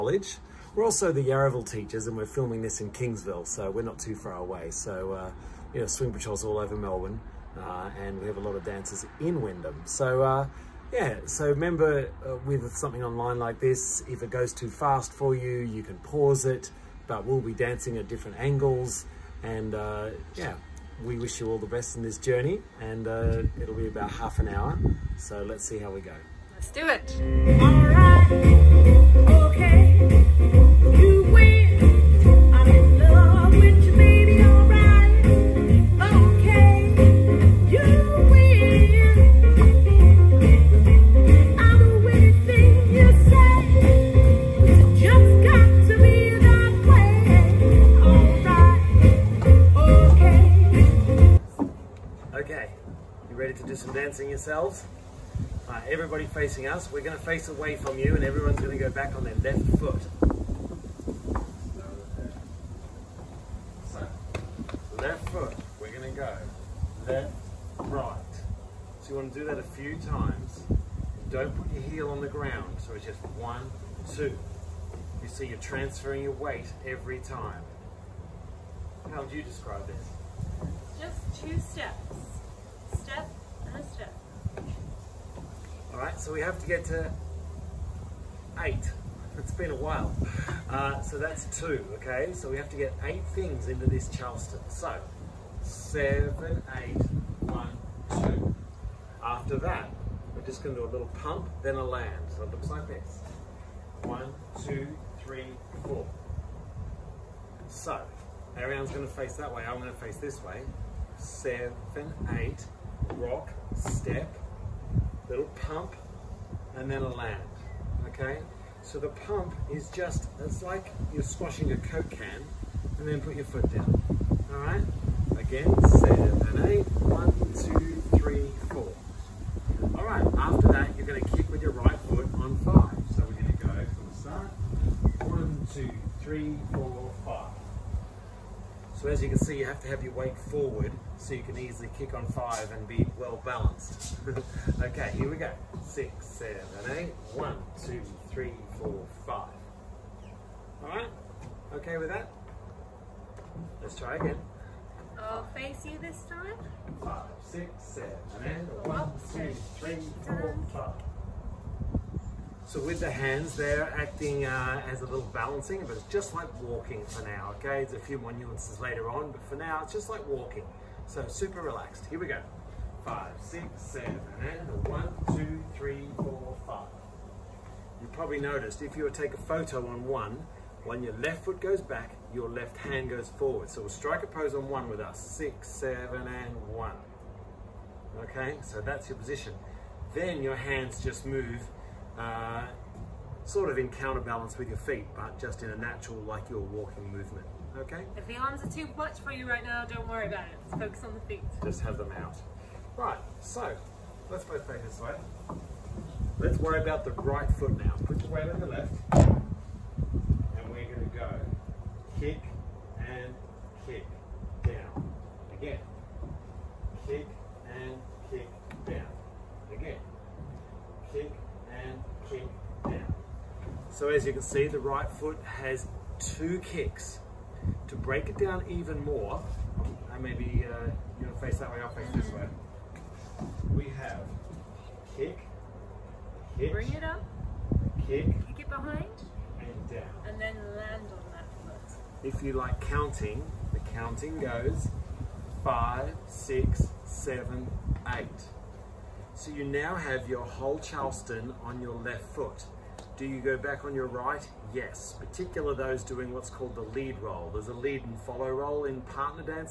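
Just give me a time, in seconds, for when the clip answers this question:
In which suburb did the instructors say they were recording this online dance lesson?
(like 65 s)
2 s.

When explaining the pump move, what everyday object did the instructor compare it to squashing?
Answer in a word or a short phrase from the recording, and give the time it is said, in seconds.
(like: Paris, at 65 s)
a Coke can, at 121 s.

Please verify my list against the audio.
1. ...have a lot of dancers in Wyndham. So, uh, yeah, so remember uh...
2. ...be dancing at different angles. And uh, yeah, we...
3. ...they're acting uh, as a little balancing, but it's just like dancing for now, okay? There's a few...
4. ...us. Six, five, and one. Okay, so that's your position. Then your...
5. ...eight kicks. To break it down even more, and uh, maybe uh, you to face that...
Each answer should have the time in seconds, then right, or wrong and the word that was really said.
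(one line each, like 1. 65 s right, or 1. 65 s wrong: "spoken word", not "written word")
1. 8 s right
2. 17 s right
3. 163 s wrong: "walking", not "dancing"
4. 184 s wrong: "seven", not "five"
5. 226 s wrong: "two", not "eight".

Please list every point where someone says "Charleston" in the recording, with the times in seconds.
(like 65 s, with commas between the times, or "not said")
94 s, 250 s.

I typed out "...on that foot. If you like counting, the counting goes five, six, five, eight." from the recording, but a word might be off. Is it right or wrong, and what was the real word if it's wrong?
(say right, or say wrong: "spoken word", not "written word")
wrong: "seven", not "five".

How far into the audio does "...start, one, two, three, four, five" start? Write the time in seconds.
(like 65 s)
134 s.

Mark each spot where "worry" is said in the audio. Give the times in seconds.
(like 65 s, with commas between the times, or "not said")
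200 s, 206 s.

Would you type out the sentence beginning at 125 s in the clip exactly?
Again, seven and two, three, three, four.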